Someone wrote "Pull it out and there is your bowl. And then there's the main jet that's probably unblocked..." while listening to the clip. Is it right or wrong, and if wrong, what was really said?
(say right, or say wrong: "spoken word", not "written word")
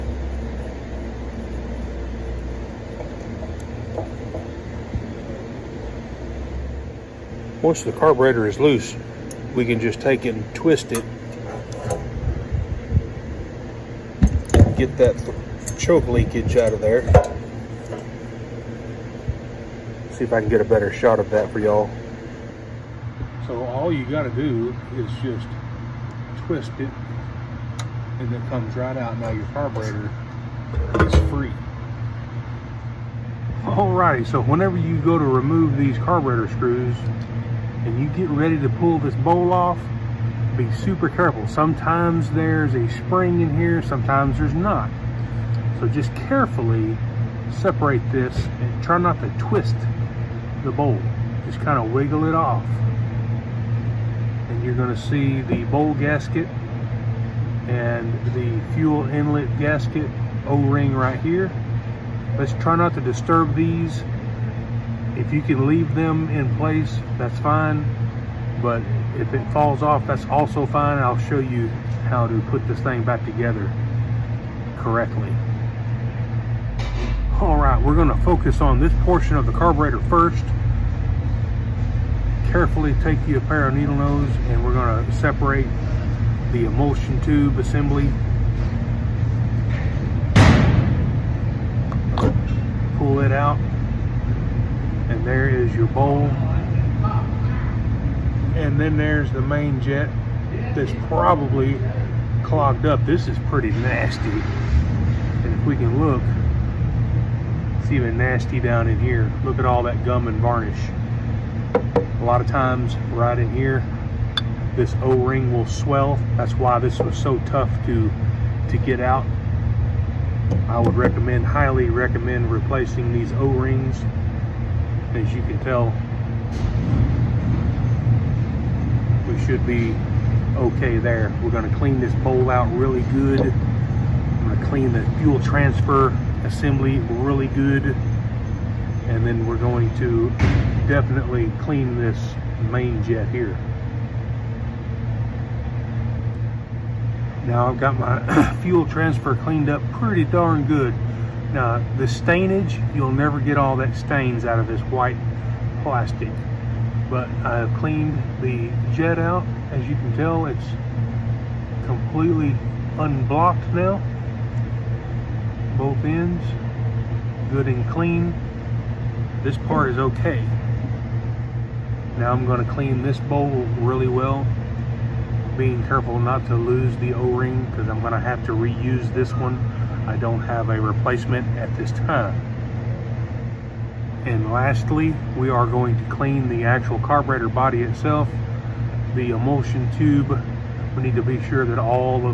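wrong: "clogged", not "unblocked".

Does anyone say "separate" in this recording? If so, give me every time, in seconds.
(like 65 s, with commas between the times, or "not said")
47 s, 85 s.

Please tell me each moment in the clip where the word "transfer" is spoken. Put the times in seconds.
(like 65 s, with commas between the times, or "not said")
135 s, 148 s.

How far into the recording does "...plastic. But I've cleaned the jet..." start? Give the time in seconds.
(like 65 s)
155 s.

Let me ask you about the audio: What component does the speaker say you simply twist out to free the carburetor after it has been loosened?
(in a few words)
choke linkage.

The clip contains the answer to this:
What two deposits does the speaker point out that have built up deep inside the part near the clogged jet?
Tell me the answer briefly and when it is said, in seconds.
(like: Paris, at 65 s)
gum and varnish, at 110 s.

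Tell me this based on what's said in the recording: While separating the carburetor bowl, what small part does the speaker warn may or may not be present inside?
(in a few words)
a spring.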